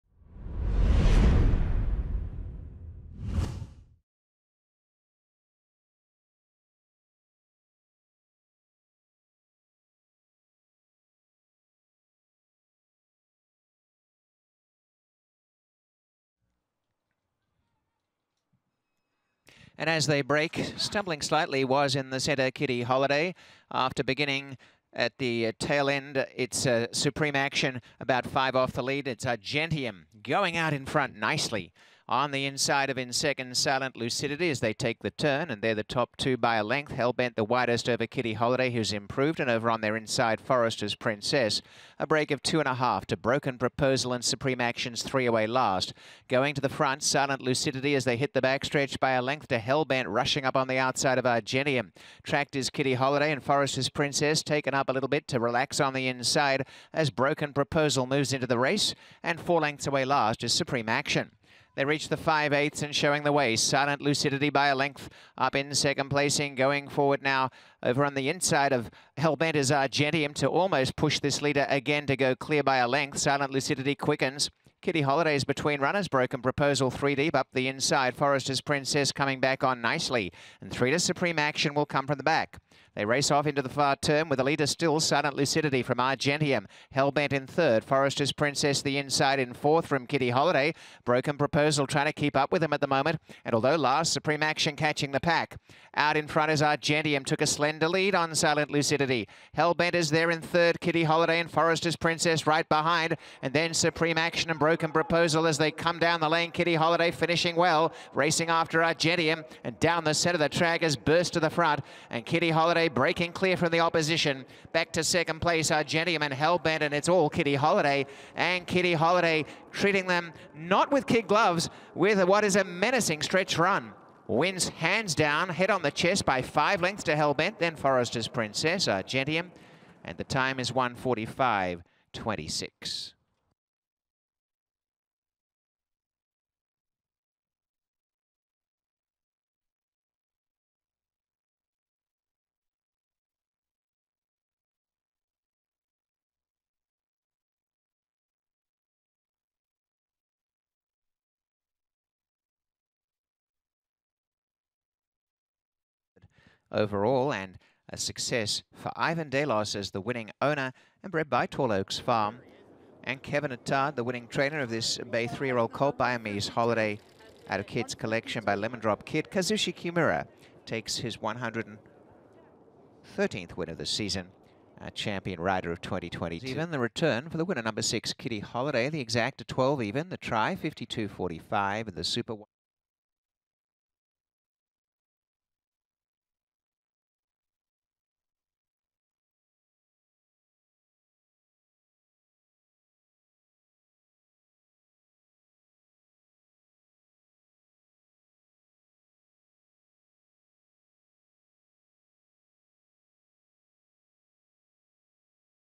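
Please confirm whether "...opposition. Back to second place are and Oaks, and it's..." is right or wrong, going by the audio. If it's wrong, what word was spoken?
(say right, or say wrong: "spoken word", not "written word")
wrong: "Hellbent", not "Oaks".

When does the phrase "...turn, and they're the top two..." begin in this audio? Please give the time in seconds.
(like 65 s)
35 s.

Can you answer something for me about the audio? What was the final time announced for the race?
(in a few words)
1:45.26.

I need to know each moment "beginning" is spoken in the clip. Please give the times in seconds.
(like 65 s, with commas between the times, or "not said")
24 s.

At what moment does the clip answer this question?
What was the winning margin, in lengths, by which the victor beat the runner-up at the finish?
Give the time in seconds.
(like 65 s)
126 s.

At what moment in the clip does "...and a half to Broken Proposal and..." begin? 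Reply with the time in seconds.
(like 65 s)
42 s.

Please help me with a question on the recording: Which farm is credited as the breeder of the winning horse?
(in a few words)
Tall Oaks Farm.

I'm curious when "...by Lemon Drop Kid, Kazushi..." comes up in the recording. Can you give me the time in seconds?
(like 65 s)
168 s.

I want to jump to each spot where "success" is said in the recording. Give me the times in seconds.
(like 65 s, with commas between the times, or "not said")
157 s.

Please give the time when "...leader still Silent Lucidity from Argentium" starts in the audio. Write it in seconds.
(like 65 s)
84 s.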